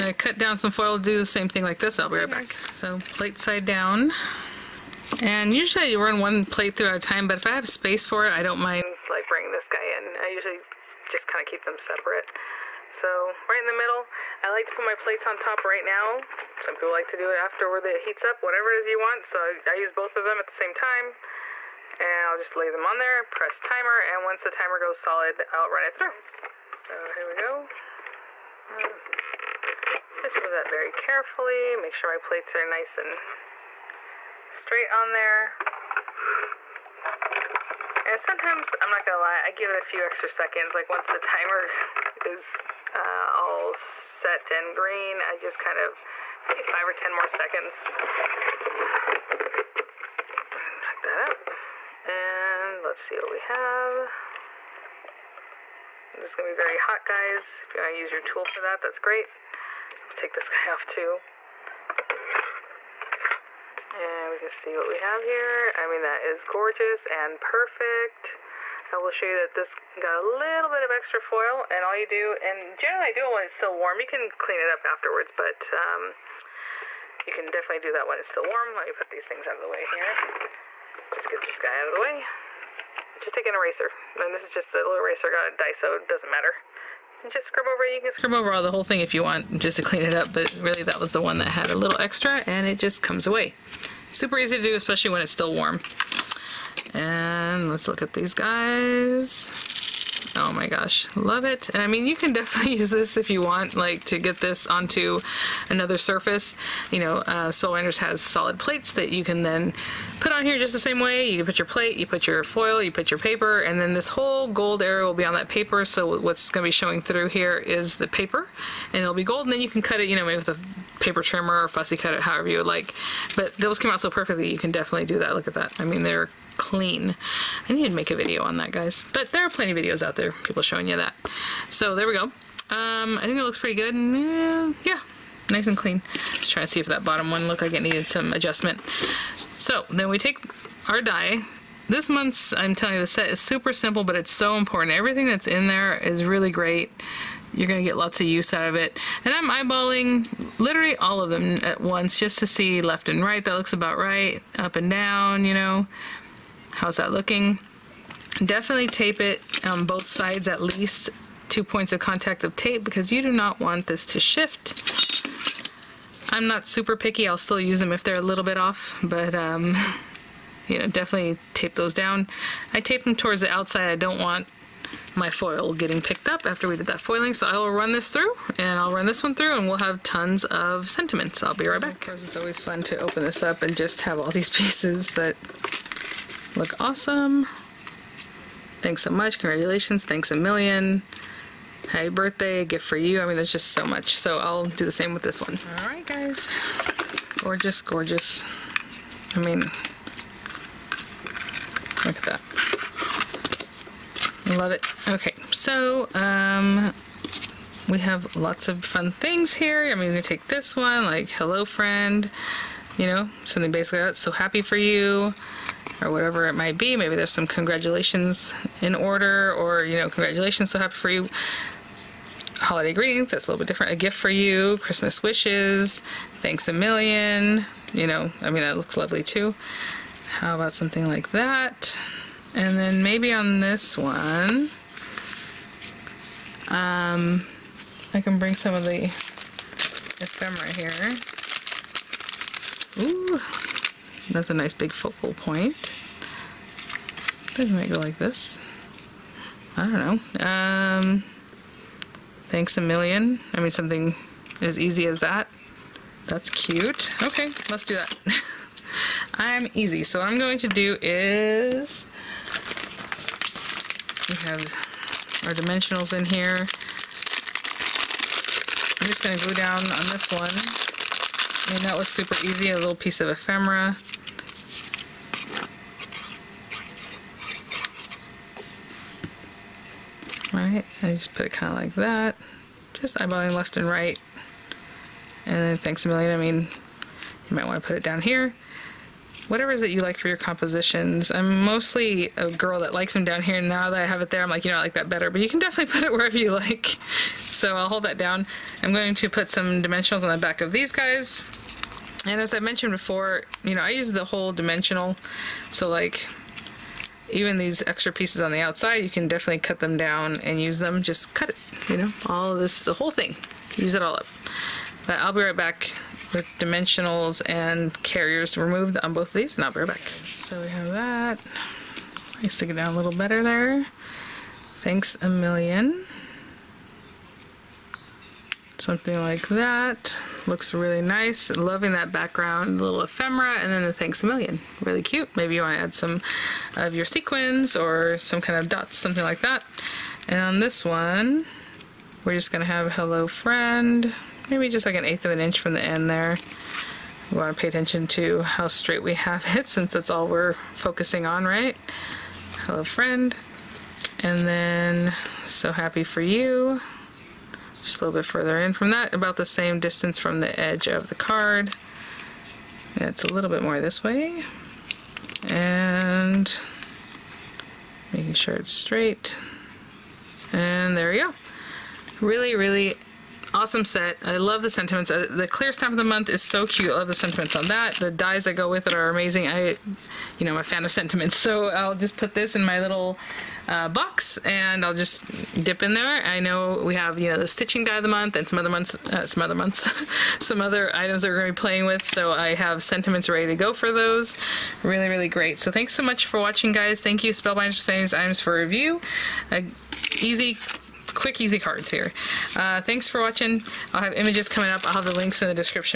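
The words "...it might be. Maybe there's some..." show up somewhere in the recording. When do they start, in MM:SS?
03:36.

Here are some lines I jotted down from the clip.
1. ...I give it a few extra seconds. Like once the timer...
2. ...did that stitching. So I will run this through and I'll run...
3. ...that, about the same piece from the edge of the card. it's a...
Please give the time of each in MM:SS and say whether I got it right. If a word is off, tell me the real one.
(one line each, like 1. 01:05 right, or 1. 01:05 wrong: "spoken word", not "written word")
1. 00:39 right
2. 02:56 wrong: "foiling", not "stitching"
3. 05:58 wrong: "distance", not "piece".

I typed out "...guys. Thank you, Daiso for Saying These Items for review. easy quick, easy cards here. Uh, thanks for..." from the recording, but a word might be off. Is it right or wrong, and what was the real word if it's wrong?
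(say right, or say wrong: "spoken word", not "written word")
wrong: "Spellbinders", not "Daiso".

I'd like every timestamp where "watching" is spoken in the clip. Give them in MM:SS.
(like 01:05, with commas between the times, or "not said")
06:36, 06:43.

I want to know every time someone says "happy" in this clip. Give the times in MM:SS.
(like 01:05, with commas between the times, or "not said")
03:11, 03:34, 03:40, 05:55.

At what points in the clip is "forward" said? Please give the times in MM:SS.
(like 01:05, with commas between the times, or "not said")
not said.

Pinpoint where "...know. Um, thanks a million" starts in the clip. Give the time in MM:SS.
04:10.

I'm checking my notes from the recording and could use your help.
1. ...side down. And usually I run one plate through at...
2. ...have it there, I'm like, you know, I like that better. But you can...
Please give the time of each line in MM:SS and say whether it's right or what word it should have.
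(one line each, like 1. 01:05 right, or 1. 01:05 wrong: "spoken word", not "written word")
1. 00:03 right
2. 04:54 right.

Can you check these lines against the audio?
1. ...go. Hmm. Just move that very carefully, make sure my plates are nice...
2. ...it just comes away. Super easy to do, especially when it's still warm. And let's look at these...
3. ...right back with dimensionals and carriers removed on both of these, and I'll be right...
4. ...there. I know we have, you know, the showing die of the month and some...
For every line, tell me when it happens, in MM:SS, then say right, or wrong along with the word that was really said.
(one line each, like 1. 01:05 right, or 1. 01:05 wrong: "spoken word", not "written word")
1. 00:27 right
2. 01:32 right
3. 05:15 right
4. 06:25 wrong: "stitching", not "showing".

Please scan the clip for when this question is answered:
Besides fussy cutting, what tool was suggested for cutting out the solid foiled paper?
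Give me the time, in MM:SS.
02:00.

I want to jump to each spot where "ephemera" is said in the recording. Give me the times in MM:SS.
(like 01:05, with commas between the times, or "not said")
03:59, 04:33, 05:33.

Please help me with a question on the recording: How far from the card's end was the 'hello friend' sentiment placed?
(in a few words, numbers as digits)
an eighth of an inch.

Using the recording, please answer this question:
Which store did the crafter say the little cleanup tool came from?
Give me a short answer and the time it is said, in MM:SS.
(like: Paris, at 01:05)
Daiso, at 01:25.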